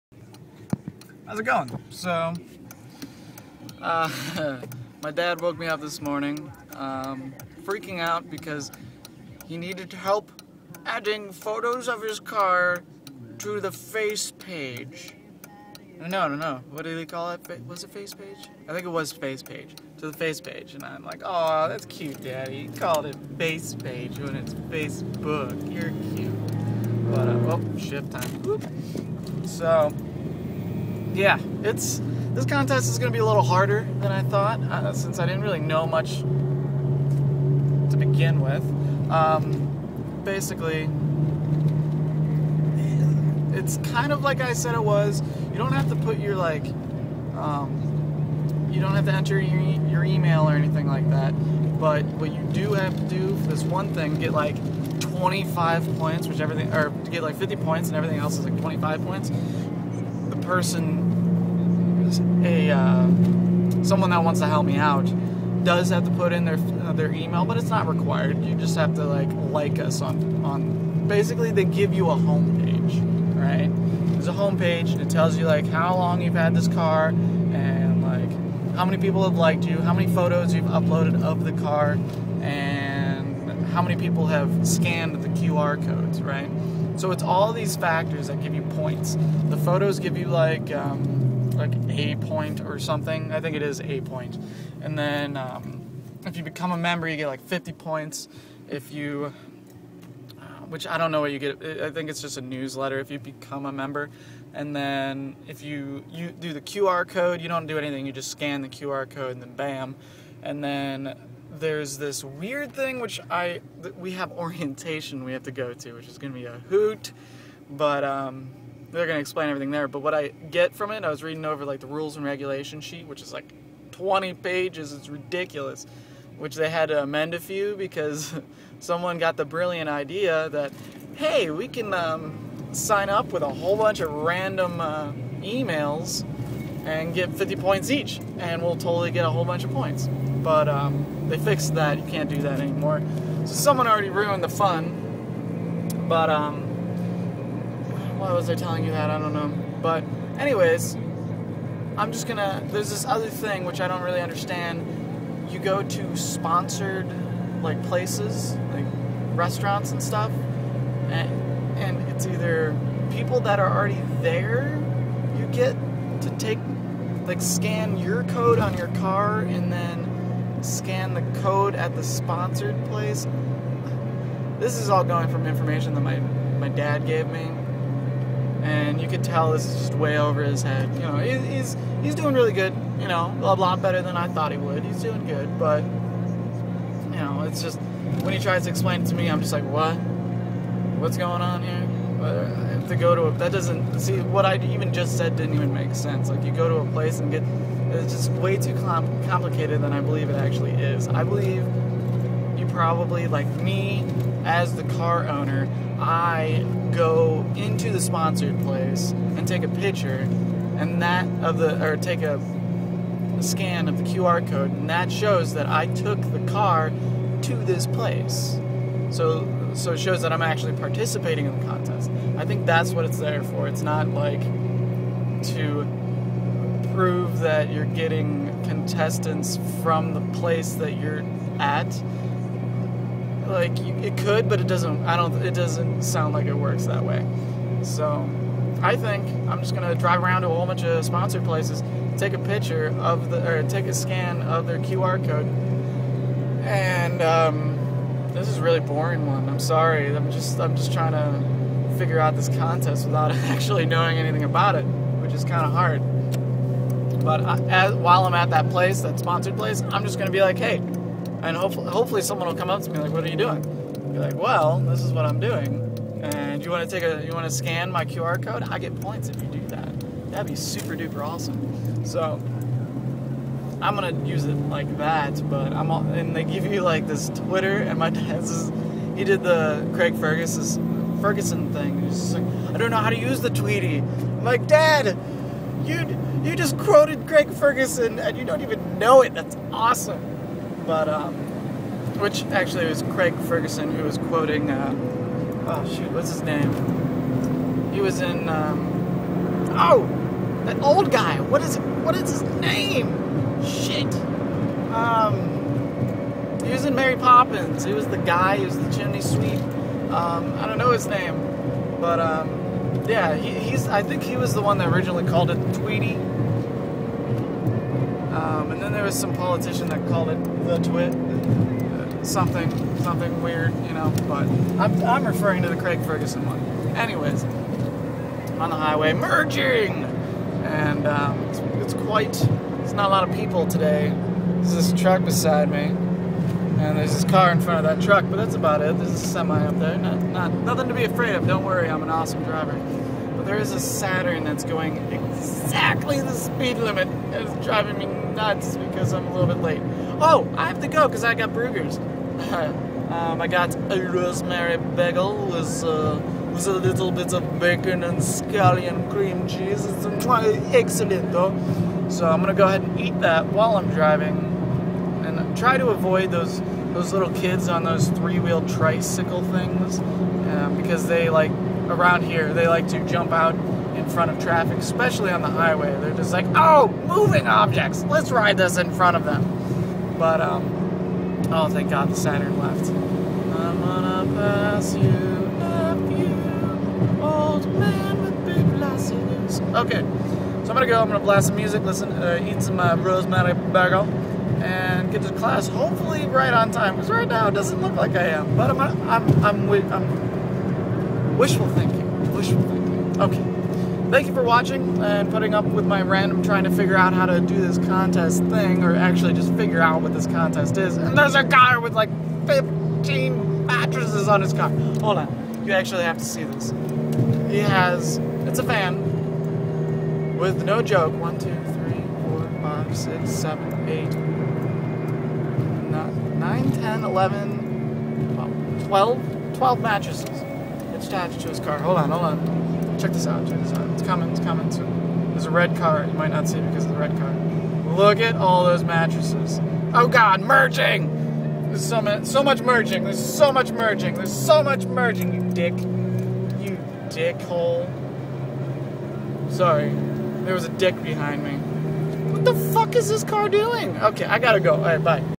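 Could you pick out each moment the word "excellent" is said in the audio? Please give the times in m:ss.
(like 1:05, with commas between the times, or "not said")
6:00.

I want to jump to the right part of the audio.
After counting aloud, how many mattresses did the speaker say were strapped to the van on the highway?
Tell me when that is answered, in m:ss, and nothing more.
7:09.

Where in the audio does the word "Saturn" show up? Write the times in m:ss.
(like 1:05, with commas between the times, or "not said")
5:43, 6:22.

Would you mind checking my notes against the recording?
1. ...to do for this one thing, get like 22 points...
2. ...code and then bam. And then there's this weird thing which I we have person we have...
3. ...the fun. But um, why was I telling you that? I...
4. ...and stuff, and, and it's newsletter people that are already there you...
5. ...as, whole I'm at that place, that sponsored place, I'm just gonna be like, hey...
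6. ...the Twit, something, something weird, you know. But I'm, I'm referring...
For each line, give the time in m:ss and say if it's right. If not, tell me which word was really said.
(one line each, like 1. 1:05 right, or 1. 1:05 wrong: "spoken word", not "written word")
1. 0:52 wrong: "25", not "22"
2. 1:49 wrong: "orientation", not "person"
3. 2:24 right
4. 2:39 wrong: "either", not "newsletter"
5. 4:17 wrong: "while", not "whole"
6. 5:20 right.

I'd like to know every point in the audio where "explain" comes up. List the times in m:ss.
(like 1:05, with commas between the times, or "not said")
1:59, 3:08.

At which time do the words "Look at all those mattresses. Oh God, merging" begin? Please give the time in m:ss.
7:17.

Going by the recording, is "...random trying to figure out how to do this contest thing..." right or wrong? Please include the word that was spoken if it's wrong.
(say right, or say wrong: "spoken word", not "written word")
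right.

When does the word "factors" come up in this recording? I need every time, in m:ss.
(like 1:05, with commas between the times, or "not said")
1:27.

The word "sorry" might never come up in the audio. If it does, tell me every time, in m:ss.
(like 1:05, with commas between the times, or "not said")
4:09, 7:29.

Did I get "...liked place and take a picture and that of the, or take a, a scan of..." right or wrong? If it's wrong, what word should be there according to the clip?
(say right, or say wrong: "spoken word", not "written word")
wrong: "sponsored", not "liked".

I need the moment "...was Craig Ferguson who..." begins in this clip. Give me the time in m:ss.
4:52.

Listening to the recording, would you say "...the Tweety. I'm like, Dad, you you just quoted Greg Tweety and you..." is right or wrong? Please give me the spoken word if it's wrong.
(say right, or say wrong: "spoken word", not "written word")
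wrong: "Ferguson", not "Tweety".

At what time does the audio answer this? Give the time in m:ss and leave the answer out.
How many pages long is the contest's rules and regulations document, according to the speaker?
2:03.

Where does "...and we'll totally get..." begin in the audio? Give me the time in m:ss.
2:18.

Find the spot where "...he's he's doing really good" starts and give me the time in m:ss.
3:01.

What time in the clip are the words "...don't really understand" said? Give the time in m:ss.
2:33.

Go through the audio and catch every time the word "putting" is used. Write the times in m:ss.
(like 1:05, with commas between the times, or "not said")
6:45.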